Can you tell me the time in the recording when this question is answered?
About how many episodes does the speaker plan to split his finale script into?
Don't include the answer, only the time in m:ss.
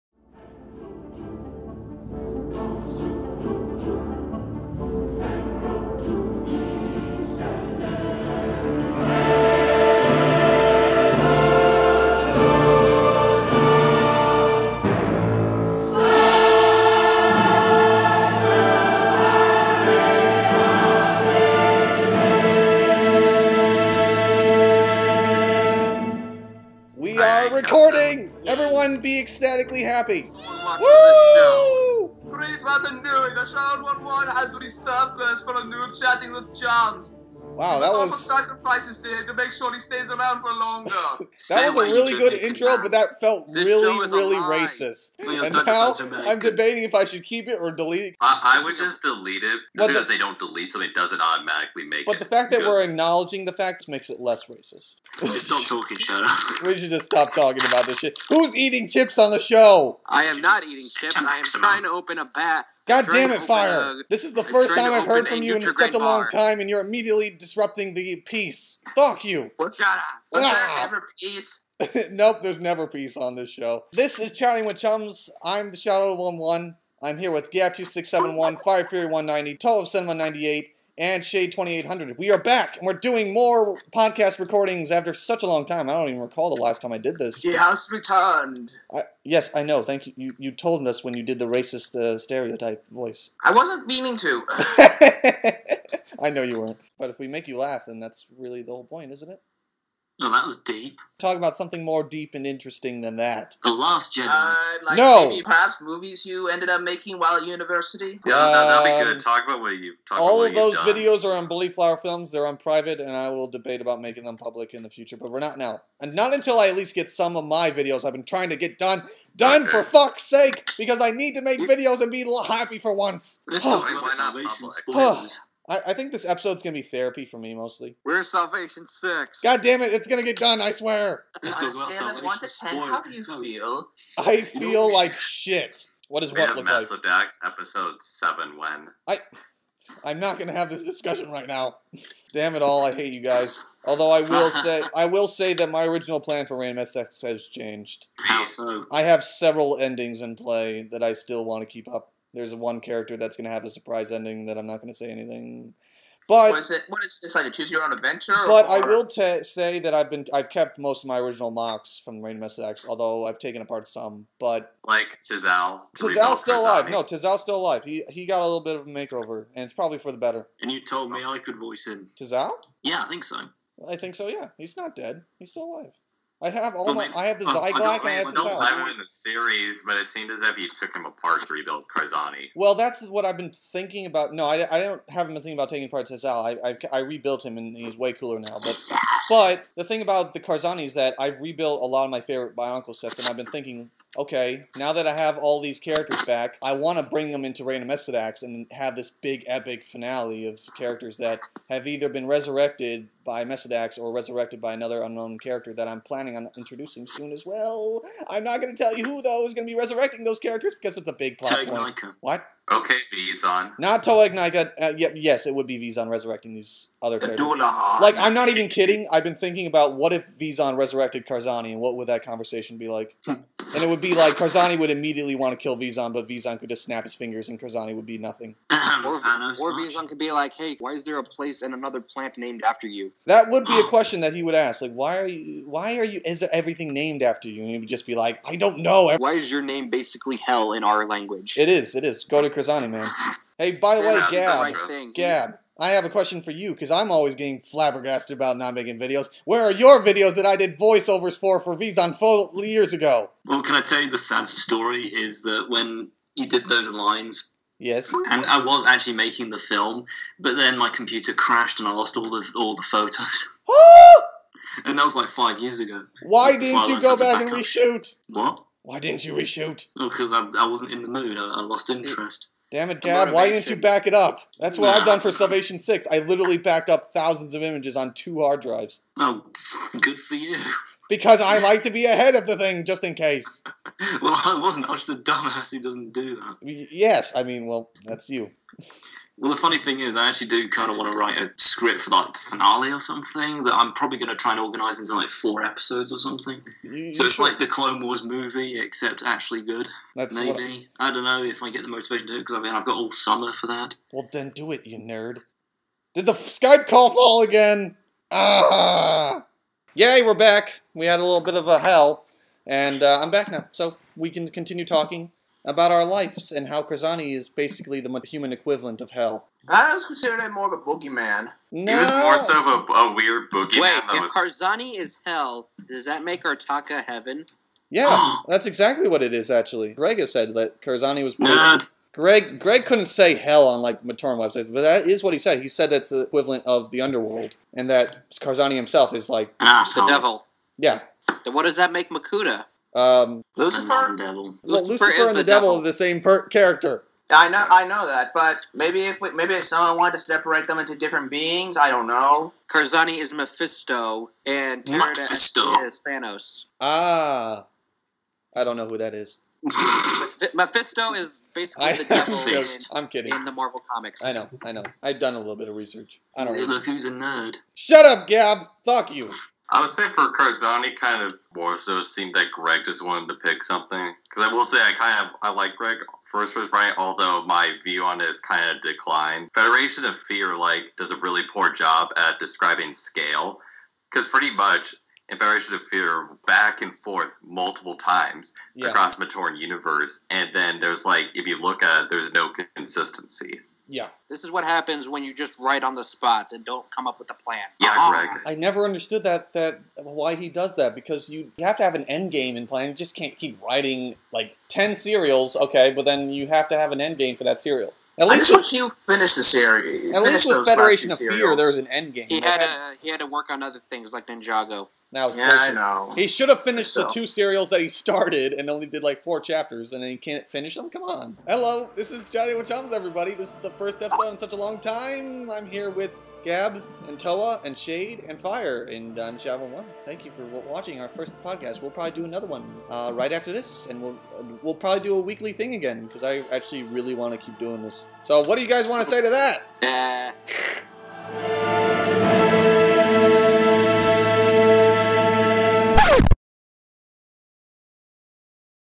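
4:55.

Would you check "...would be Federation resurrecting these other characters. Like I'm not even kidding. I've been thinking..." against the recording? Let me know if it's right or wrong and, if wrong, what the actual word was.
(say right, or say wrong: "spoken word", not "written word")
wrong: "Vezon", not "Federation".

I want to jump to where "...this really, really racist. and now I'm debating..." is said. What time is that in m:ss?
0:43.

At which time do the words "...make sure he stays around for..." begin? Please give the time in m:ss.
0:39.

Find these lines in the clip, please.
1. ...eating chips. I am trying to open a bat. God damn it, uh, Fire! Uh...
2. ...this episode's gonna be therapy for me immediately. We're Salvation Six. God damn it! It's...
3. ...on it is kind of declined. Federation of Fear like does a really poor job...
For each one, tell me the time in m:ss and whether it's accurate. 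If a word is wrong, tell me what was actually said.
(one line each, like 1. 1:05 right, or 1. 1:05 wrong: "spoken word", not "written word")
1. 1:00 right
2. 2:06 wrong: "mostly", not "immediately"
3. 6:18 right.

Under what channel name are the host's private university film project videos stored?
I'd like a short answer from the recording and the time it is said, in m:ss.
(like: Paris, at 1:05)
Belief Flower Films, at 1:51.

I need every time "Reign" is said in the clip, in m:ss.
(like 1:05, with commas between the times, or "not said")
2:26, 2:42, 3:17.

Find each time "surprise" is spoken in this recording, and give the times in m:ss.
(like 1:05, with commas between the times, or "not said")
2:33.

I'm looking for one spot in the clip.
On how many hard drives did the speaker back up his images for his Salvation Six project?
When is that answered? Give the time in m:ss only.
4:38.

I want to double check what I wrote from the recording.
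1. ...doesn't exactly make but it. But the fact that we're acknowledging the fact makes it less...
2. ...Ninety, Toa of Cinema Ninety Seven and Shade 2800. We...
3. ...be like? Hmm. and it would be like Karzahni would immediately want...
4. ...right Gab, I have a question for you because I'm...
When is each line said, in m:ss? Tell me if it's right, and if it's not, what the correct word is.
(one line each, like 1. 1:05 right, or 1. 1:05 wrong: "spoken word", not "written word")
1. 0:50 wrong: "automatically", not "exactly"
2. 1:19 wrong: "Eight", not "Seven"
3. 3:42 right
4. 4:04 right.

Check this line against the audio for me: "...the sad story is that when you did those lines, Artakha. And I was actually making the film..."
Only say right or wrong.
wrong.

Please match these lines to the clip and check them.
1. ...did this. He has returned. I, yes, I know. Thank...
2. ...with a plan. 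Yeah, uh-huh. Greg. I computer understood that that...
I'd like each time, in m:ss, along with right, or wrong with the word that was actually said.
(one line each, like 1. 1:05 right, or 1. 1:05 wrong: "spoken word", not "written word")
1. 1:26 right
2. 6:37 wrong: "never", not "computer".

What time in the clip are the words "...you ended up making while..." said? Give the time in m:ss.
1:46.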